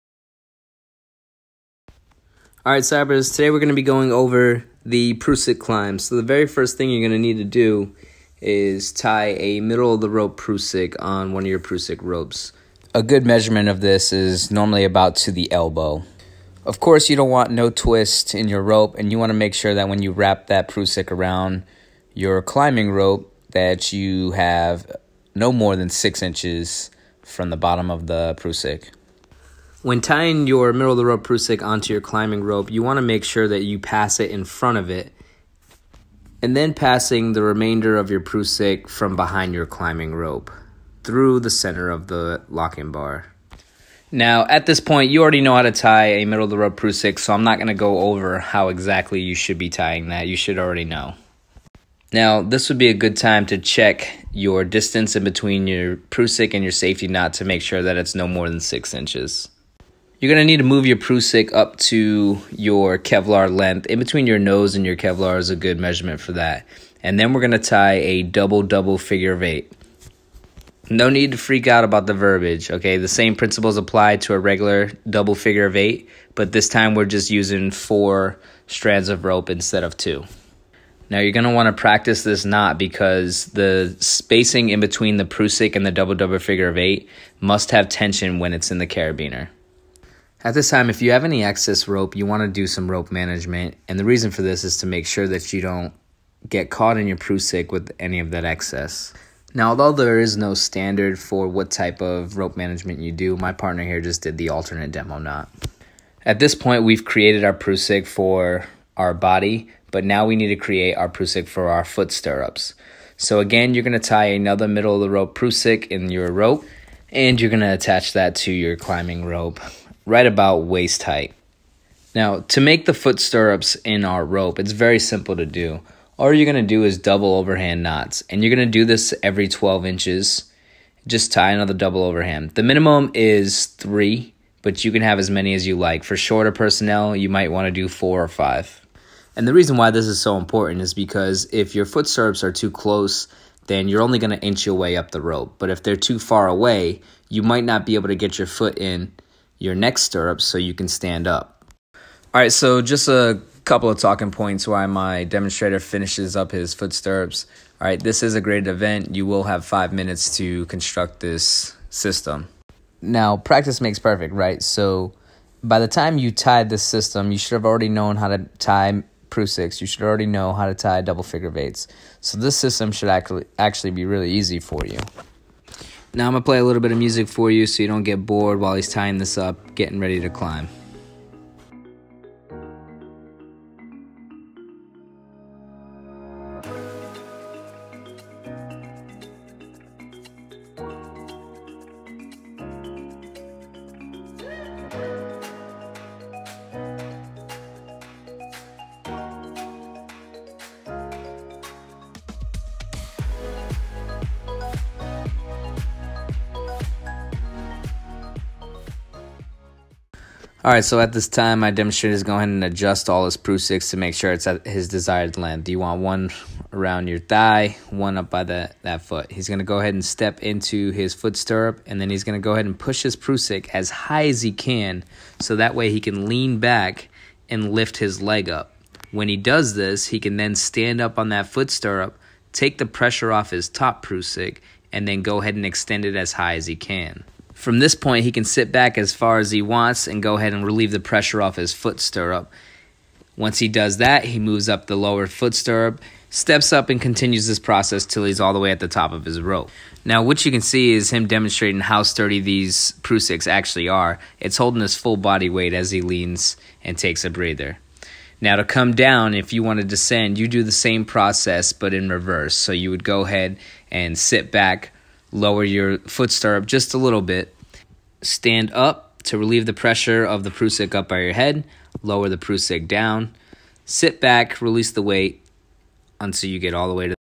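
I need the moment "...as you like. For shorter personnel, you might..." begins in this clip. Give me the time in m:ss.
2:15.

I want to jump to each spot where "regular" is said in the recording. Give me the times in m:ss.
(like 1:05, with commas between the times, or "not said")
1:14.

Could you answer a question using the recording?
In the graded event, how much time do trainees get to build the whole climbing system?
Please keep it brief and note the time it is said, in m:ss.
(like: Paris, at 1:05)
5 minutes, at 2:39.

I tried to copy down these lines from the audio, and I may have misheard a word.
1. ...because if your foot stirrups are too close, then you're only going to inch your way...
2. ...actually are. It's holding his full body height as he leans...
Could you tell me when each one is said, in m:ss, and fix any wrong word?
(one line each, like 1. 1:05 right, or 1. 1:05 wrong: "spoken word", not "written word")
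1. 2:20 right
2. 4:13 wrong: "weight", not "height".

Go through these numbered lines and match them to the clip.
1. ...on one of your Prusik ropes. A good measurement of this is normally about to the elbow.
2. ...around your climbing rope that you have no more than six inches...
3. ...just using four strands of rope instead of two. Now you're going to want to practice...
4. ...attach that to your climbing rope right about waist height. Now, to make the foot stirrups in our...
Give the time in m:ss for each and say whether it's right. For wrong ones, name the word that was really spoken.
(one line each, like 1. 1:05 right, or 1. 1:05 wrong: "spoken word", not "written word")
1. 0:10 right
2. 0:21 right
3. 1:17 right
4. 1:57 right.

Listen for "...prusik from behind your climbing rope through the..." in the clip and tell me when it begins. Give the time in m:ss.
0:38.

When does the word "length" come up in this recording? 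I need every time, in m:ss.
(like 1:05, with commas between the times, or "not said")
1:03, 3:35.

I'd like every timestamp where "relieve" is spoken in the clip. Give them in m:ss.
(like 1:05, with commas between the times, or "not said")
4:00, 4:29.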